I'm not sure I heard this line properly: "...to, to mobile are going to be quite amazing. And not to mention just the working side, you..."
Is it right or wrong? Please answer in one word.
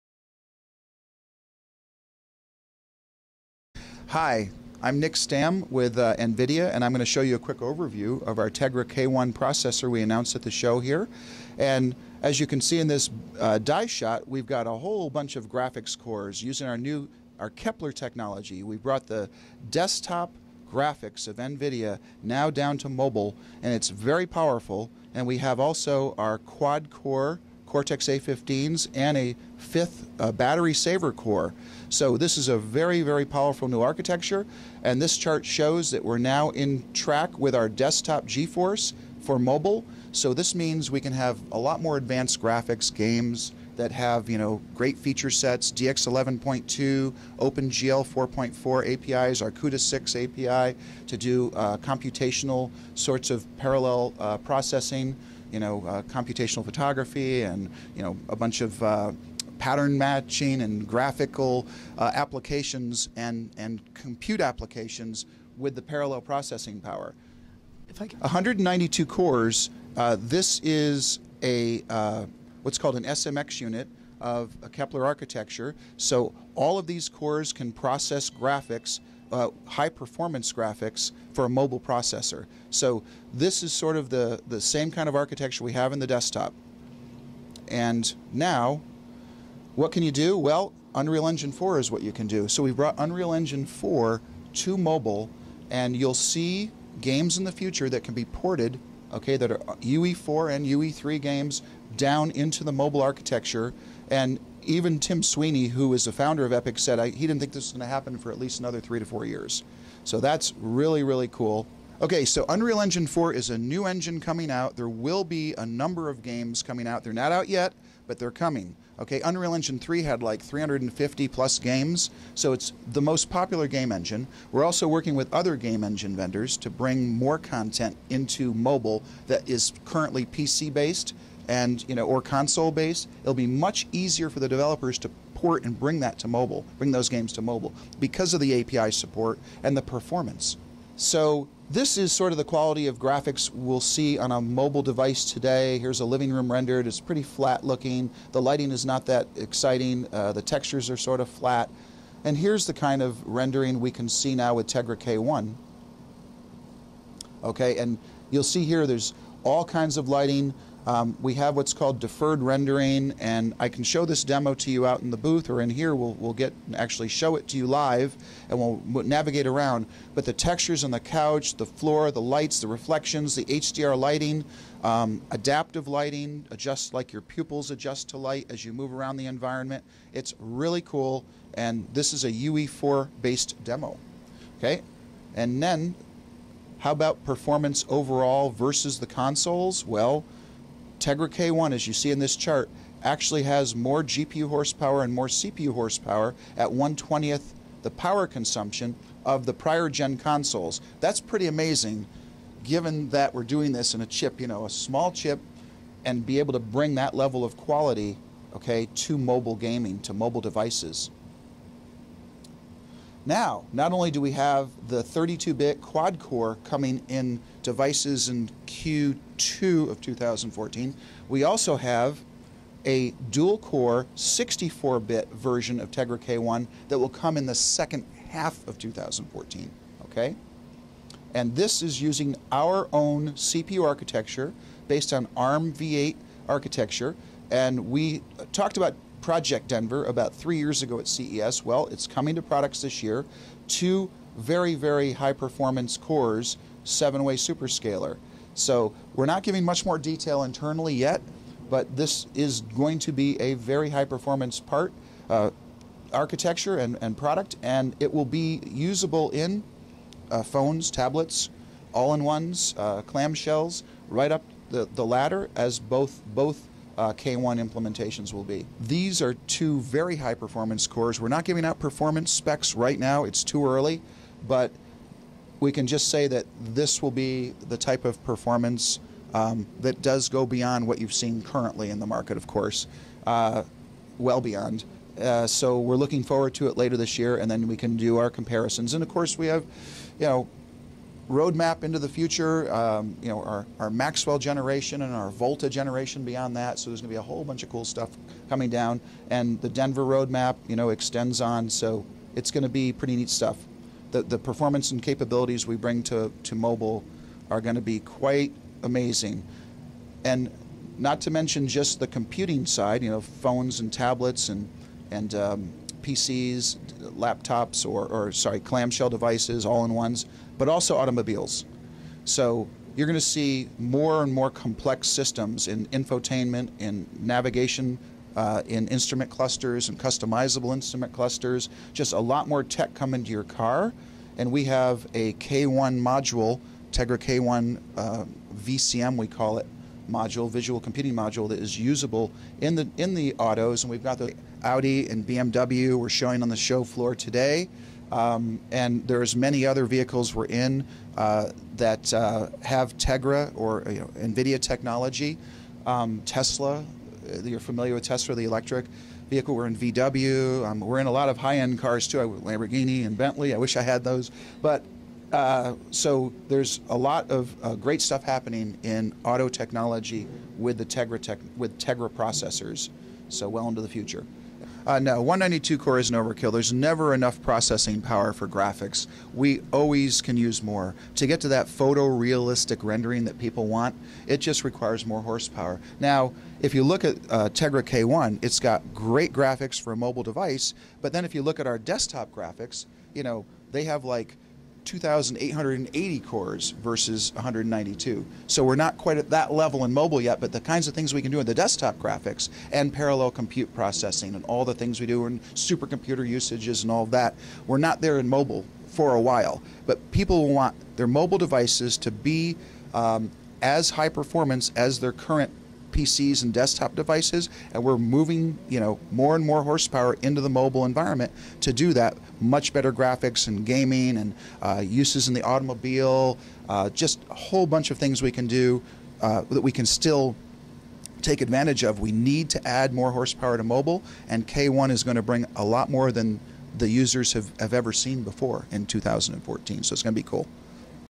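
wrong.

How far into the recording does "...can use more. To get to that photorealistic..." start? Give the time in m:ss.
6:20.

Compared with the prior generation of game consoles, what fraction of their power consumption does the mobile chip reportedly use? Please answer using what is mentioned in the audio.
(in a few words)
1/120th.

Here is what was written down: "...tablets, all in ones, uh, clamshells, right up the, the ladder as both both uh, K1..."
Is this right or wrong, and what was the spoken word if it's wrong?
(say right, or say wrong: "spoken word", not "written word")
right.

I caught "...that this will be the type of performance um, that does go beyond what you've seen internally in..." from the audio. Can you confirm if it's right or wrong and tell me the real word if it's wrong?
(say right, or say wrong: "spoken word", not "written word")
wrong: "currently", not "internally".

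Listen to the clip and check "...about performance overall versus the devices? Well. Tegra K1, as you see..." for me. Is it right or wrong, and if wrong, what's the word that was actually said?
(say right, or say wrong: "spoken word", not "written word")
wrong: "consoles", not "devices".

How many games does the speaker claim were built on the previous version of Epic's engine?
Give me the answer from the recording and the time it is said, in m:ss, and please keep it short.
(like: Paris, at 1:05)
350+, at 2:00.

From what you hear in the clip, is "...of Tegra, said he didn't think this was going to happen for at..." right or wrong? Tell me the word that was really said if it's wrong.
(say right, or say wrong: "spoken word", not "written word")
wrong: "Epic", not "Tegra".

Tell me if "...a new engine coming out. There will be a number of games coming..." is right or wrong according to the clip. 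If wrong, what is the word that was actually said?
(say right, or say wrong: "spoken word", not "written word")
right.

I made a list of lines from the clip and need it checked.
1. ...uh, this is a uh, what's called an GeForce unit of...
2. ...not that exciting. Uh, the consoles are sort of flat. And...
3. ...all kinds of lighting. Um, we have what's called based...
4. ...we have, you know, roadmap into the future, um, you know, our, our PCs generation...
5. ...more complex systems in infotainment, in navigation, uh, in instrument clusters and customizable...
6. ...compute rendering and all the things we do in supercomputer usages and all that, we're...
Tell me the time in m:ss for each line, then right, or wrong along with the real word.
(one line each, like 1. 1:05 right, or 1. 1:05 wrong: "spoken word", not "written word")
1. 1:09 wrong: "SMX", not "GeForce"
2. 2:28 wrong: "textures", not "consoles"
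3. 2:39 wrong: "deferred", not "based"
4. 4:49 wrong: "Maxwell", not "PCs"
5. 5:24 right
6. 6:43 wrong: "processing", not "rendering".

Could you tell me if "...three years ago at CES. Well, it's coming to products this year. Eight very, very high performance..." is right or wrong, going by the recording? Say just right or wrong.
wrong.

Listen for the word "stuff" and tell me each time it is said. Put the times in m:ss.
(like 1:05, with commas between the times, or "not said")
4:57, 5:03, 6:08.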